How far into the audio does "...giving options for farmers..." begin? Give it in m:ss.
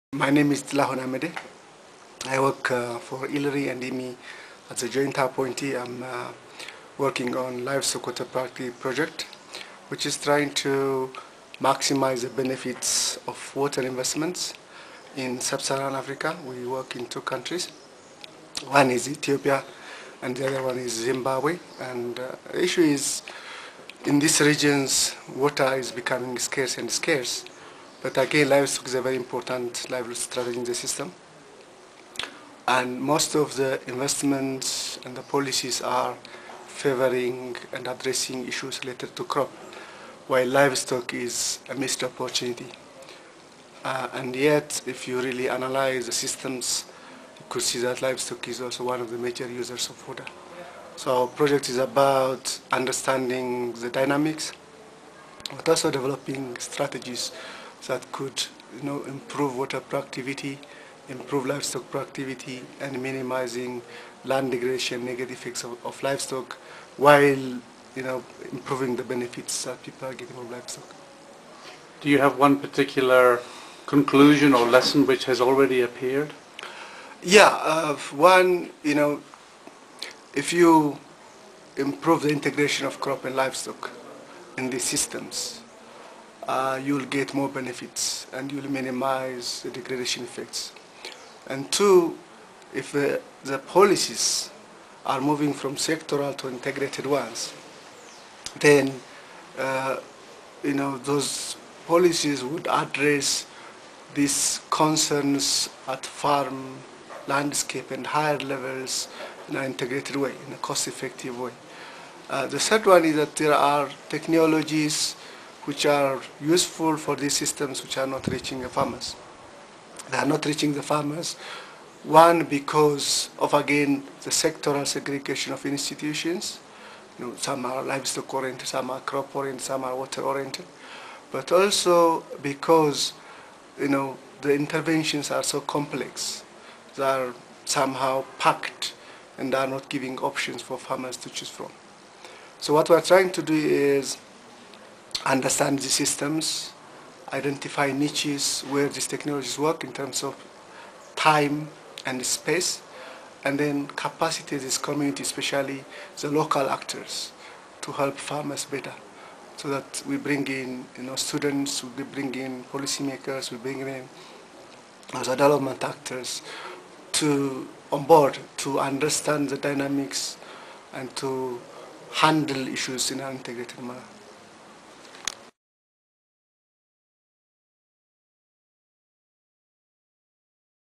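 2:19.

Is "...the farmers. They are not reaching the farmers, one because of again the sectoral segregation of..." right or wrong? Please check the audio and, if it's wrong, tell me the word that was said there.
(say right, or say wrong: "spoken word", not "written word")
right.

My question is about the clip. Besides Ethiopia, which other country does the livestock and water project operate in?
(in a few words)
Zimbabwe.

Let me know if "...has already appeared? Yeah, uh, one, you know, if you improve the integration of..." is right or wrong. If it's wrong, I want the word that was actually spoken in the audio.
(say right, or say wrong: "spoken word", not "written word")
right.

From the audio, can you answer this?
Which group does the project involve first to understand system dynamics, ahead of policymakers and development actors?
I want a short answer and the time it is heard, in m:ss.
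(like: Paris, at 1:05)
students, at 2:41.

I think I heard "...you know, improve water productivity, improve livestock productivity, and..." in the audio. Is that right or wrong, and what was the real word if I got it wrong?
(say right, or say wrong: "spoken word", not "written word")
right.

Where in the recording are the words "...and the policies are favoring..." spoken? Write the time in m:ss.
0:35.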